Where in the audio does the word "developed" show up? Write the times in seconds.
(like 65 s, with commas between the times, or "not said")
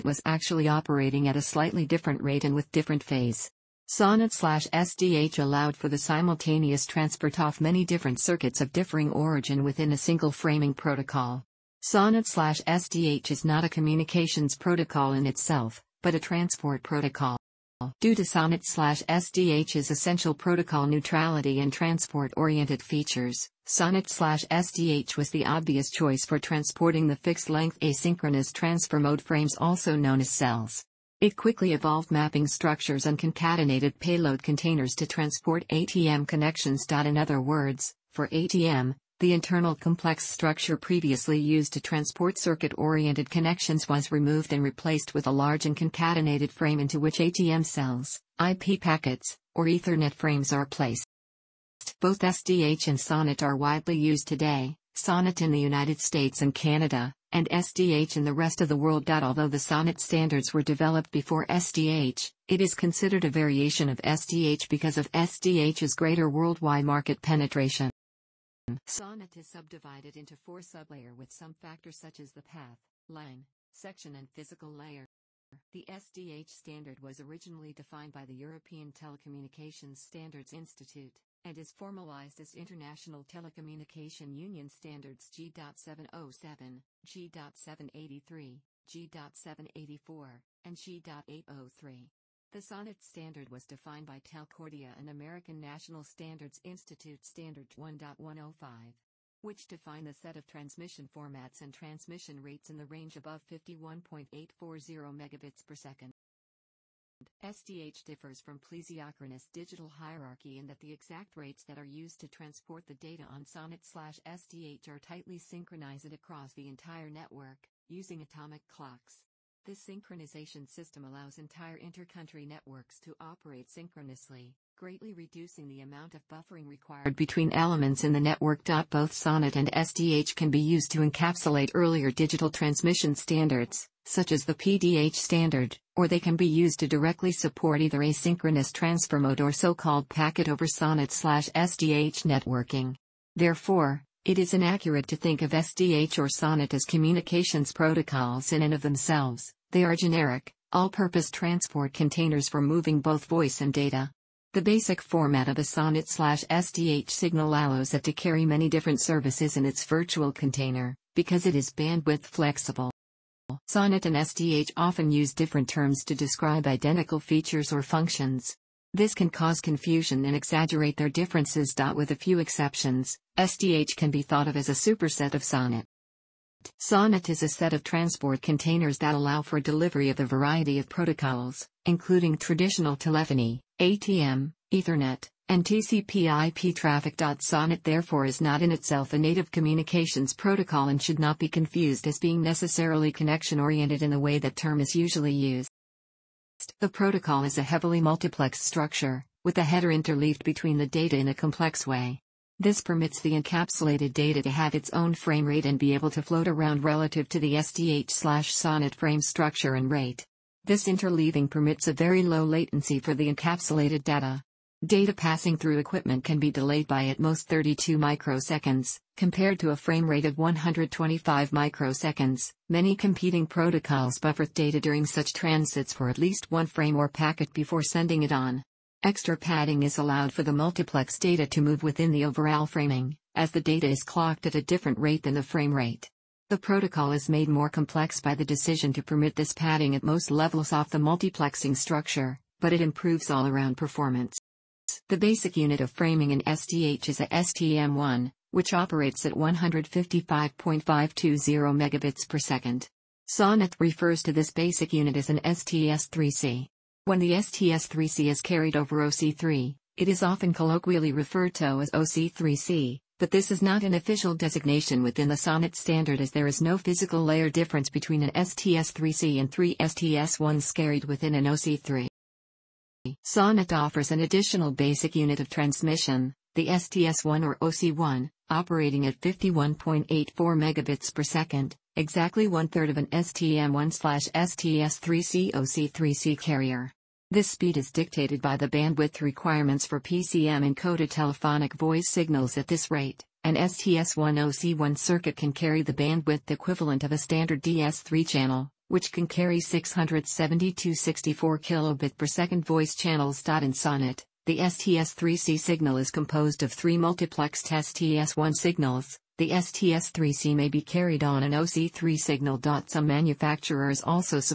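60 s.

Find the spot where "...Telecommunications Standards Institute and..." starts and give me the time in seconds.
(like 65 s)
78 s.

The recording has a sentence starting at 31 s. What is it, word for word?
It quickly evolved mapping structures and concatenated payload containers to transport ATM connections.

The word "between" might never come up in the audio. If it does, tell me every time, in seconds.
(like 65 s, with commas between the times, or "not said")
127 s, 200 s, 267 s.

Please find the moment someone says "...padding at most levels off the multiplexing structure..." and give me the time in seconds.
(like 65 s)
239 s.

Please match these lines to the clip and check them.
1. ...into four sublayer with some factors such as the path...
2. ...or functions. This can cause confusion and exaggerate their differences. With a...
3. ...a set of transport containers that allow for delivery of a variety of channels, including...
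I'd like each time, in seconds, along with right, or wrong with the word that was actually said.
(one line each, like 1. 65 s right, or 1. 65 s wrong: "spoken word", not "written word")
1. 70 s right
2. 167 s right
3. 177 s wrong: "protocols", not "channels".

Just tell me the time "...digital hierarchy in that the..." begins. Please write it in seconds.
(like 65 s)
109 s.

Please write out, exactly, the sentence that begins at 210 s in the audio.
This interleaving permits a very low latency for the encapsulated data.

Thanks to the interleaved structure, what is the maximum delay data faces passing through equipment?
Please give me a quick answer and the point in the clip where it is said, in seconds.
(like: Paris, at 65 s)
32 microseconds, at 217 s.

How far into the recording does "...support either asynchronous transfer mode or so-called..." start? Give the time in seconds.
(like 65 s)
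137 s.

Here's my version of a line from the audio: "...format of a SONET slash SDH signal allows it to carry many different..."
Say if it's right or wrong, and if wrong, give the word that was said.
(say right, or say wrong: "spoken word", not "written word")
right.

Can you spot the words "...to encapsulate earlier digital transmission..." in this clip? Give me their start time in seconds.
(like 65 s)
130 s.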